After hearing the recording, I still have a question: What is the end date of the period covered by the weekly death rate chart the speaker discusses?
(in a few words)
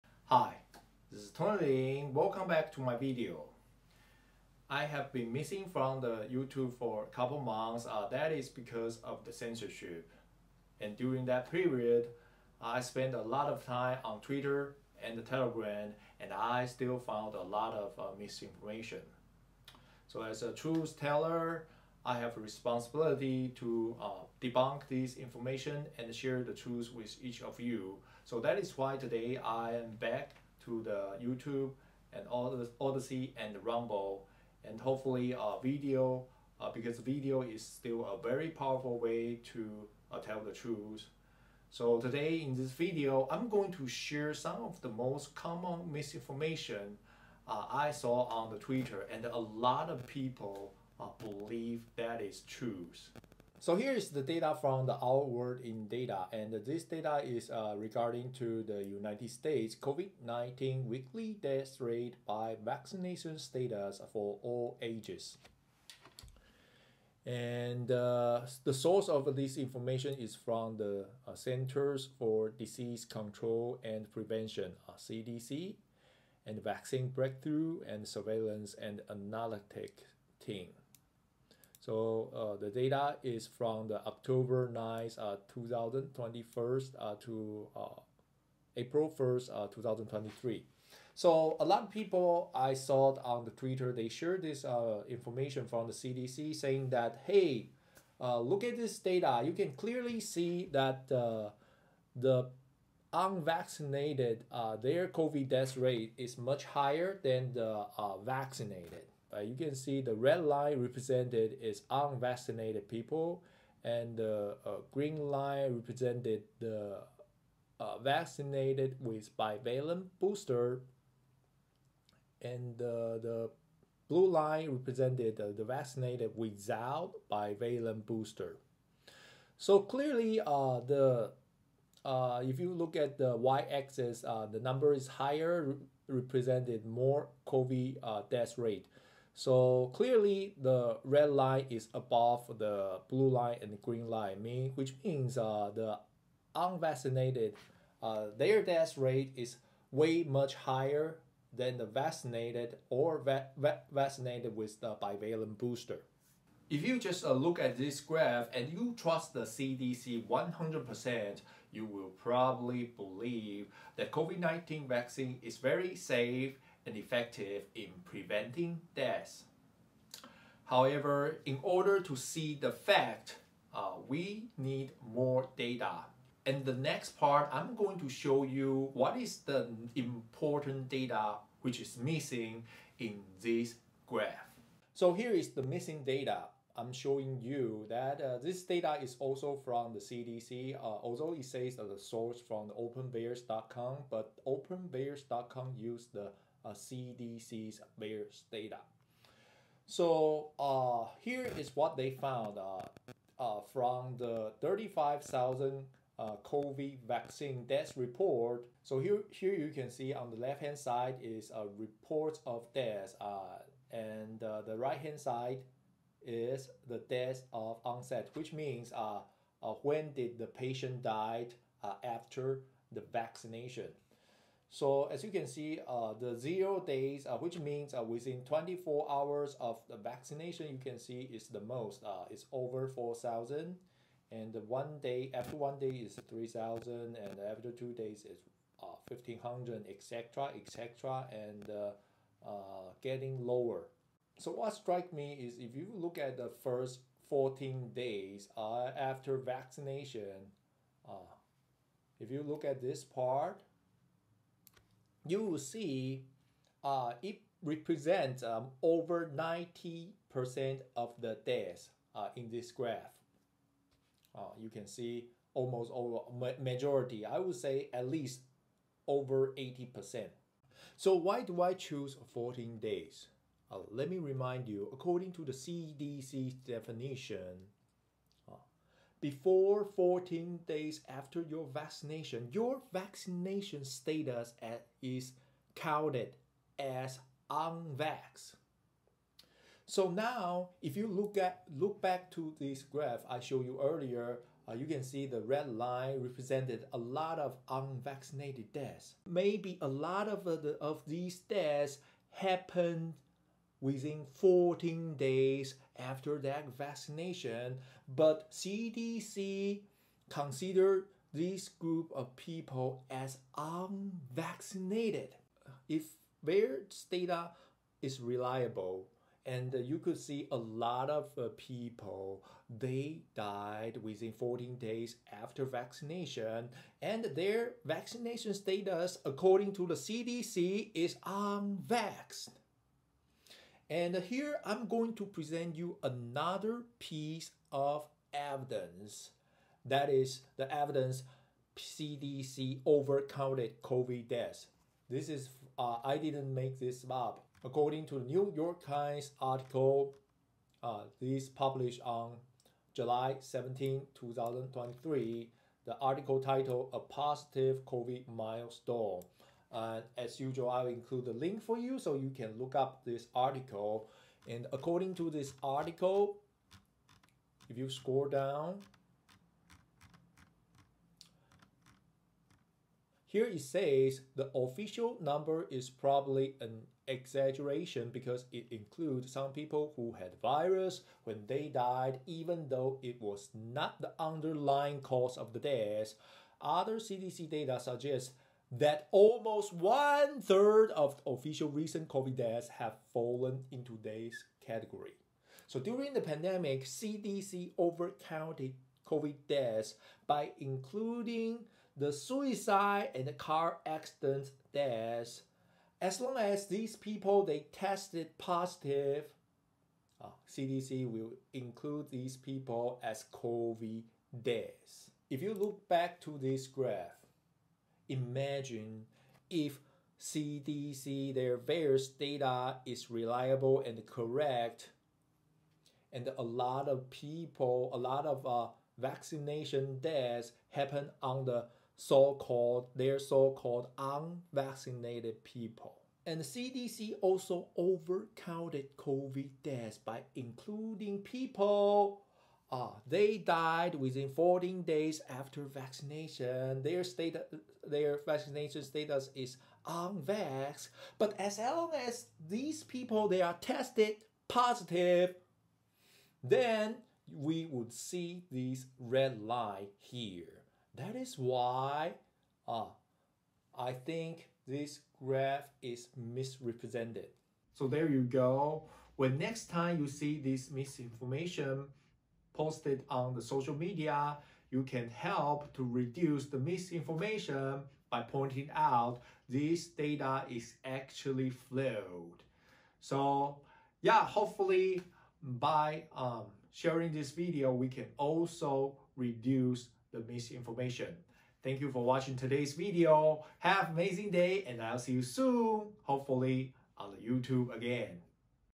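April 1st, 2023.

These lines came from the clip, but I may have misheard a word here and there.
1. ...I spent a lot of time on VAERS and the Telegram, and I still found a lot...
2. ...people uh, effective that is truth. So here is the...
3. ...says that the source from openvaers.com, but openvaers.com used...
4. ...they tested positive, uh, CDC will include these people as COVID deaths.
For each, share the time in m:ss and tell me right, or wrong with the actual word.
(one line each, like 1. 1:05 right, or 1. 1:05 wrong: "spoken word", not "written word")
1. 0:12 wrong: "Twitter", not "VAERS"
2. 0:50 wrong: "believe", not "effective"
3. 3:11 right
4. 6:47 right.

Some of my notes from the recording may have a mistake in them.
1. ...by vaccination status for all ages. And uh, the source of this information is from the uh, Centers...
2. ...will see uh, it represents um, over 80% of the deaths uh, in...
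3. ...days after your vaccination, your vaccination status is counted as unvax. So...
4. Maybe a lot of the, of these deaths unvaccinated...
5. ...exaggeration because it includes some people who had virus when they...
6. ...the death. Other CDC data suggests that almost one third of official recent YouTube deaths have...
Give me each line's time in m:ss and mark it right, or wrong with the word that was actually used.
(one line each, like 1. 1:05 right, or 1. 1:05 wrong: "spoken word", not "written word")
1. 1:02 right
2. 4:15 wrong: "90", not "80"
3. 4:40 right
4. 4:59 wrong: "happened", not "unvaccinated"
5. 6:17 right
6. 6:25 wrong: "COVID", not "YouTube".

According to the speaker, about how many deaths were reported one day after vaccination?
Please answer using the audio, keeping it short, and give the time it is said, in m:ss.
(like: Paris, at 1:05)
3,000, at 3:56.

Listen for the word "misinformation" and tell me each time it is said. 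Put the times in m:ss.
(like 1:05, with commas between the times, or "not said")
0:18, 0:45, 7:50, 7:56, 8:10.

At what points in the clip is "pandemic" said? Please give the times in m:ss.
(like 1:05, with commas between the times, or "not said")
6:36.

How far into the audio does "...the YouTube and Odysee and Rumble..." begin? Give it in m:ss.
0:30.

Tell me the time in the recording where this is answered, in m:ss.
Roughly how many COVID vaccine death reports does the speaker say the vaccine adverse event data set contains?
3:24.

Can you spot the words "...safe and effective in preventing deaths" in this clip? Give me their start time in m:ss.
2:45.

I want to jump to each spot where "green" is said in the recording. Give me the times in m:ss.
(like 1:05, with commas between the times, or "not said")
1:54, 2:23.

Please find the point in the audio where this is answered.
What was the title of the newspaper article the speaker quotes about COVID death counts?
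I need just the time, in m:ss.
5:56.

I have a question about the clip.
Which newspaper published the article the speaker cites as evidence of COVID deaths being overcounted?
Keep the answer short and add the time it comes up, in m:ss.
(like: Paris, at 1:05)
New York Times, at 5:48.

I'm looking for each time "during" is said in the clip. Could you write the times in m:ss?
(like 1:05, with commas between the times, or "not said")
0:10, 6:35.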